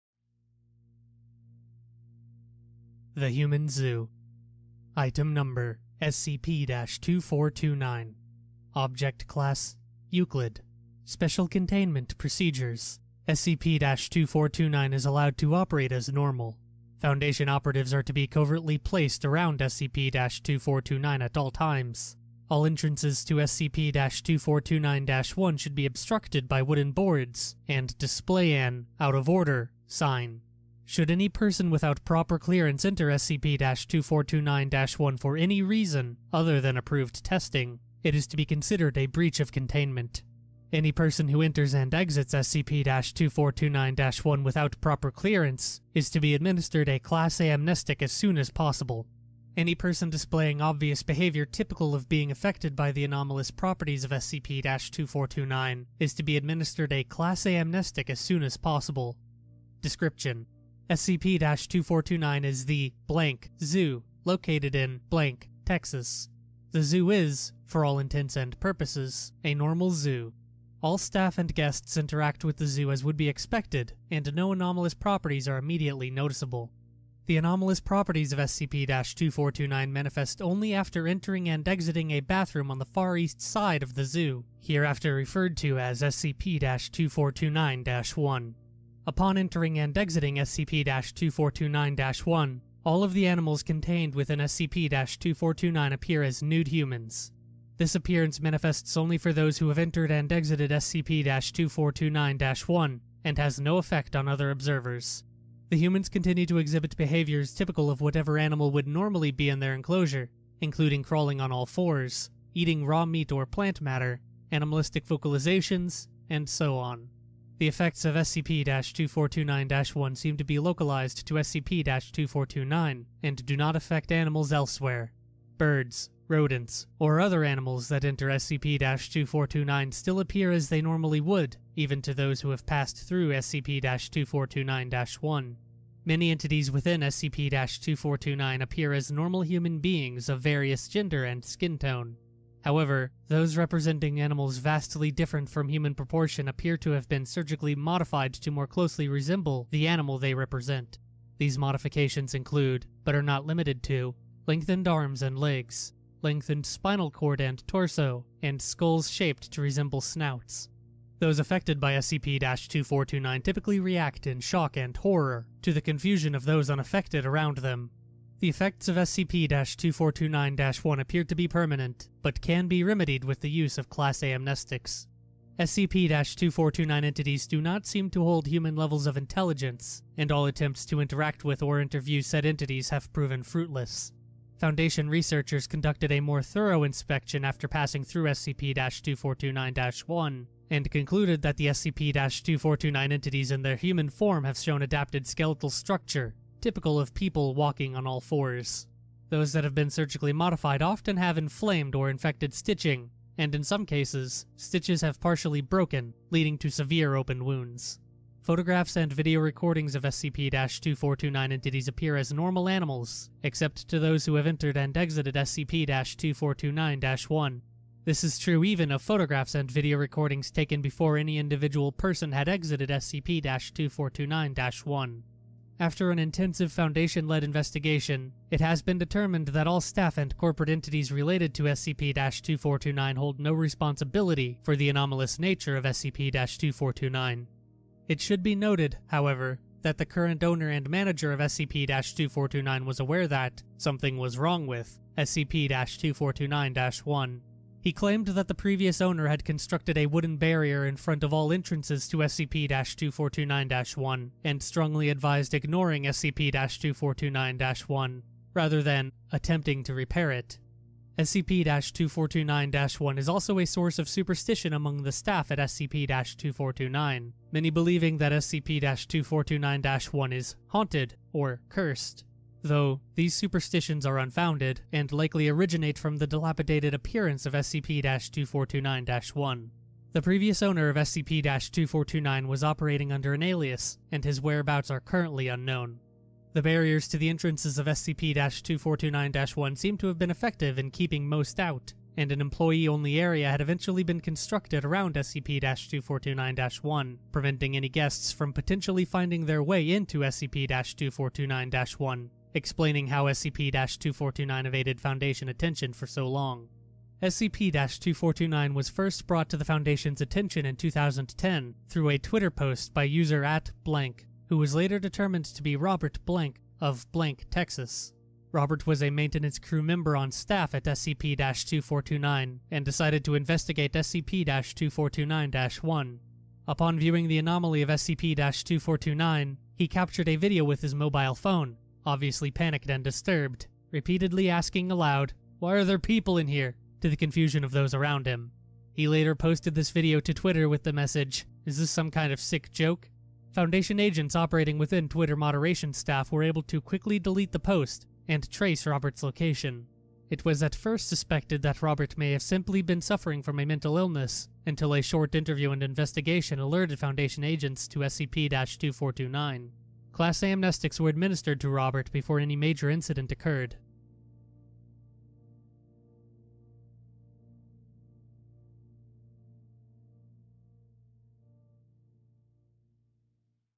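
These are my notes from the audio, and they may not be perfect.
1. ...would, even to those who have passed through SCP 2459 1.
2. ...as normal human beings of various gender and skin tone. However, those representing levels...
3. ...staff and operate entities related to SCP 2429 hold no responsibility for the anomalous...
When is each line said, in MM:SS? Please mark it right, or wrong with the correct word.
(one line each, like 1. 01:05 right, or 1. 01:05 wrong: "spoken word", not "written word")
1. 02:11 wrong: "2429", not "2459"
2. 02:18 wrong: "animals", not "levels"
3. 03:49 wrong: "corporate", not "operate".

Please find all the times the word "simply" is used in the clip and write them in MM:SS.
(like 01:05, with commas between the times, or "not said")
05:52.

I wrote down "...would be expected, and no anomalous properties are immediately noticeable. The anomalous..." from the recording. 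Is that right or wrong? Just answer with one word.
right.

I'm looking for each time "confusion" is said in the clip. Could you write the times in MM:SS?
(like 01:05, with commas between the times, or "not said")
02:45, 05:37.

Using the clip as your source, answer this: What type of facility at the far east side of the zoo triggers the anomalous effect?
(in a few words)
a bathroom.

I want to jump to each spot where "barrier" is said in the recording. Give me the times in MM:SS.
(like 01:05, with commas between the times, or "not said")
04:10, 04:46.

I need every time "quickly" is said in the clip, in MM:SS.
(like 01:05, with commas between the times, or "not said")
05:46.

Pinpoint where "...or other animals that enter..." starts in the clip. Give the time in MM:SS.
02:06.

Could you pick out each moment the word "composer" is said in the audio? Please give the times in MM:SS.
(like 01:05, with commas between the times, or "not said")
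not said.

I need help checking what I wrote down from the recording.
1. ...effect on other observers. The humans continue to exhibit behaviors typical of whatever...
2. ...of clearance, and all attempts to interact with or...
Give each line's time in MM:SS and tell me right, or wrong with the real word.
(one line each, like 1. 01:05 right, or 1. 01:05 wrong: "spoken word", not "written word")
1. 01:43 right
2. 02:59 wrong: "intelligence", not "clearance".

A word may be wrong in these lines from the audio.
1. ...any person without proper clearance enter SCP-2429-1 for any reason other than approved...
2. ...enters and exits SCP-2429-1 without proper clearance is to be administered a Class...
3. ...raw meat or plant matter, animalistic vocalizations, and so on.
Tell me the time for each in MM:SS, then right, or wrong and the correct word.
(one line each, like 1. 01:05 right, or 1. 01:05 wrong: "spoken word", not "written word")
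1. 00:31 right
2. 00:41 right
3. 01:52 right.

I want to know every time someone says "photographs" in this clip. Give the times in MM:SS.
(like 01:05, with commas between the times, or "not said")
03:28, 03:39.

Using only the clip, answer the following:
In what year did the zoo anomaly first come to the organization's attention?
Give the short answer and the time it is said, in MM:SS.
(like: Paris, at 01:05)
2010, at 05:10.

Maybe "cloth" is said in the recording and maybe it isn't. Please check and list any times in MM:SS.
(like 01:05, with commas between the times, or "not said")
not said.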